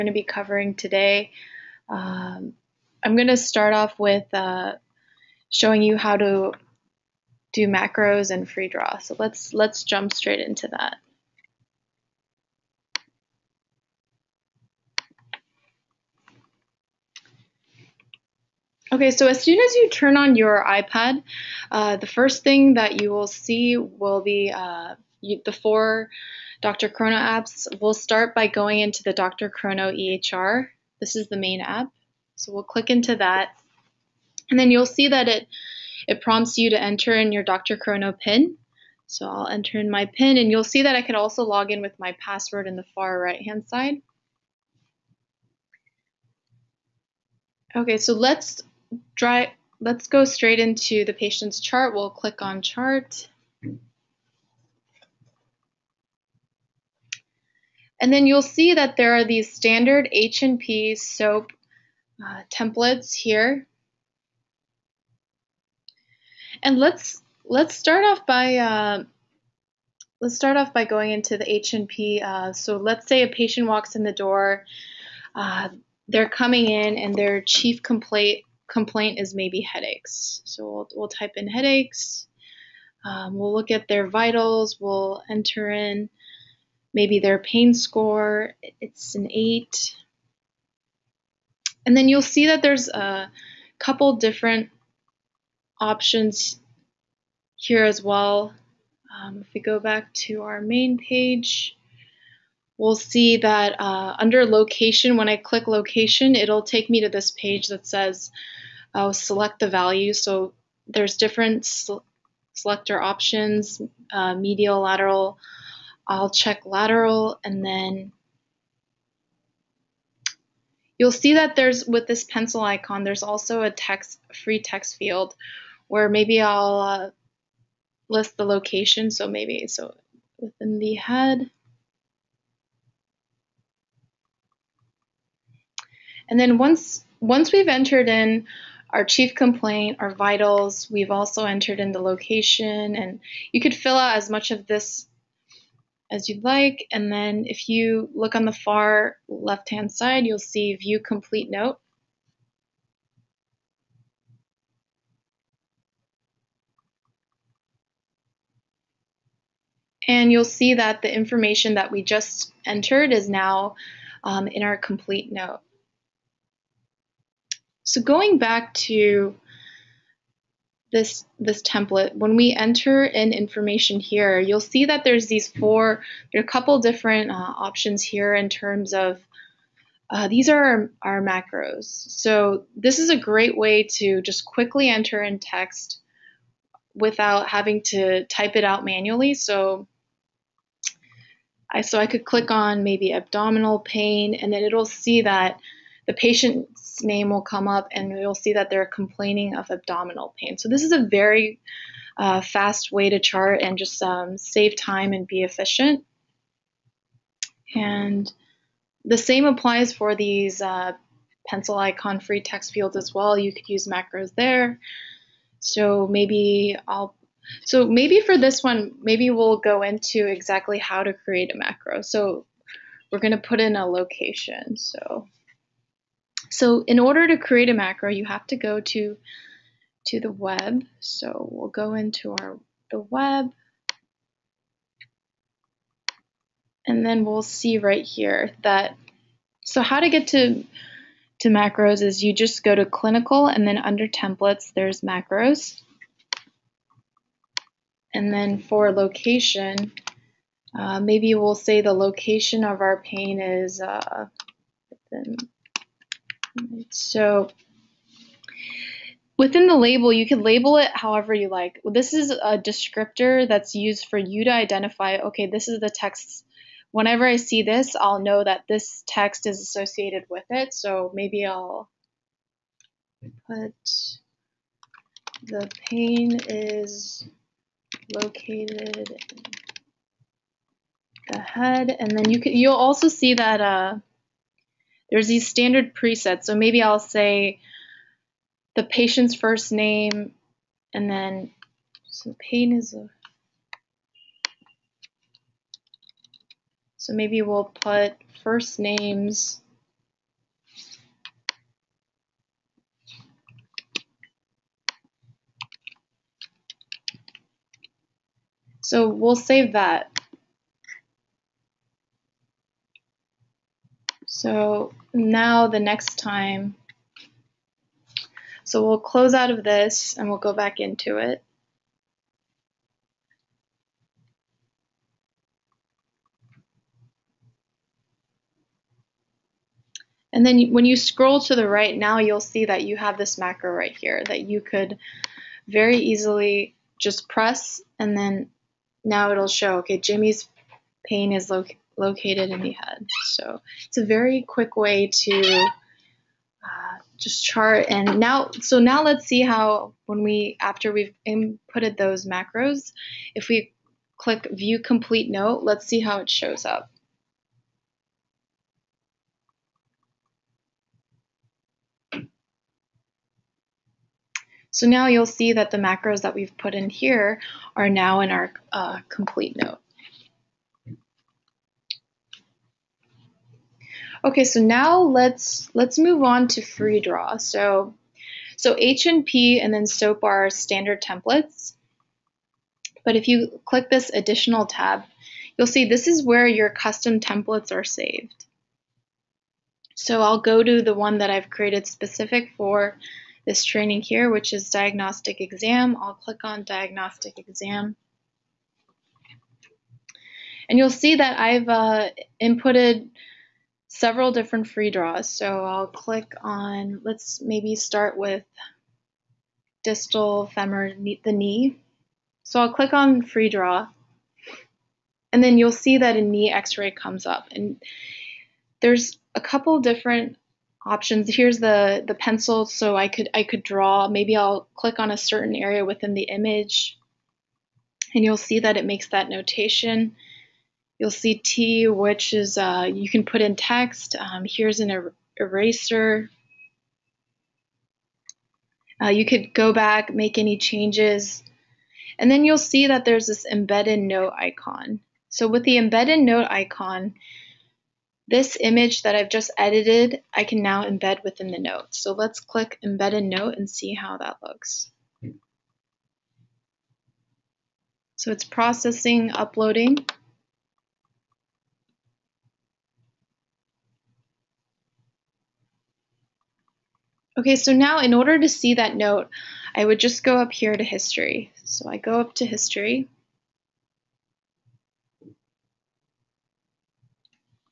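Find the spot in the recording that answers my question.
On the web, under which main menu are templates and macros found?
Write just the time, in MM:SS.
04:02.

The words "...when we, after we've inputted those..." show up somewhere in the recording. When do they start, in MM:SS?
05:50.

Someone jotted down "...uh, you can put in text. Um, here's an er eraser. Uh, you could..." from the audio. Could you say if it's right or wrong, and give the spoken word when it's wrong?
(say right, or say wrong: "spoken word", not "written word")
right.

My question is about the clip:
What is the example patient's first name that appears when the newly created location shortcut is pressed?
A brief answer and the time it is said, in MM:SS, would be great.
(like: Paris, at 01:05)
Jimmy, at 05:39.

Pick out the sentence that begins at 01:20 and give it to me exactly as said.
So we'll, we'll type in headaches.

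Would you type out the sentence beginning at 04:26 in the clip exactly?
Whenever I see this, I'll know that this text is associated with it.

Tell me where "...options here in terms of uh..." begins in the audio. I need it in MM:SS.
02:57.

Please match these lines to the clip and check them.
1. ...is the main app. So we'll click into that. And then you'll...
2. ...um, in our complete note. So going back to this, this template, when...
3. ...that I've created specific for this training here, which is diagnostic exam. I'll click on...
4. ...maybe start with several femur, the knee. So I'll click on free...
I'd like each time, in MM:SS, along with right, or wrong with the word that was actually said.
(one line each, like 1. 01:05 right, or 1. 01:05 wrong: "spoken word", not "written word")
1. 00:31 right
2. 02:44 right
3. 06:31 right
4. 06:47 wrong: "distal", not "several".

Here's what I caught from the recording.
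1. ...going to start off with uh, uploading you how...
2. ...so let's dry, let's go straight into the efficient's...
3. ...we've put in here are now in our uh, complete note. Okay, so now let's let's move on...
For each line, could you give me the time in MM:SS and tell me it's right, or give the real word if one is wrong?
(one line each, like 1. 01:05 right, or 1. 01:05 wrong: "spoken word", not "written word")
1. 00:03 wrong: "showing", not "uploading"
2. 00:47 wrong: "patient", not "efficient"
3. 06:06 right.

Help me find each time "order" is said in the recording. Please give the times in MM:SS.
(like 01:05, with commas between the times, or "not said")
03:46, 07:48.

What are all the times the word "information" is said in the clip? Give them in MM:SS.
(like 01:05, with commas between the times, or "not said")
02:41, 02:53.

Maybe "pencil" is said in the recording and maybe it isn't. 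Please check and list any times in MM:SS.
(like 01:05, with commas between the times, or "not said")
02:02, 03:31, 07:02.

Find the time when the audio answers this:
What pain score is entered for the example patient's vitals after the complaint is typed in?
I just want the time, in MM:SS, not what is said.
01:28.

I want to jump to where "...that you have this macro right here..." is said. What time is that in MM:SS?
05:32.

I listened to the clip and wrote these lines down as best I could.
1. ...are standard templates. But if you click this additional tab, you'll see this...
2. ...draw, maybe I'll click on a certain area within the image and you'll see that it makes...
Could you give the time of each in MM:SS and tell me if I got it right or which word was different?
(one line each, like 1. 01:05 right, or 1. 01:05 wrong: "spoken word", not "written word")
1. 06:20 right
2. 07:03 right.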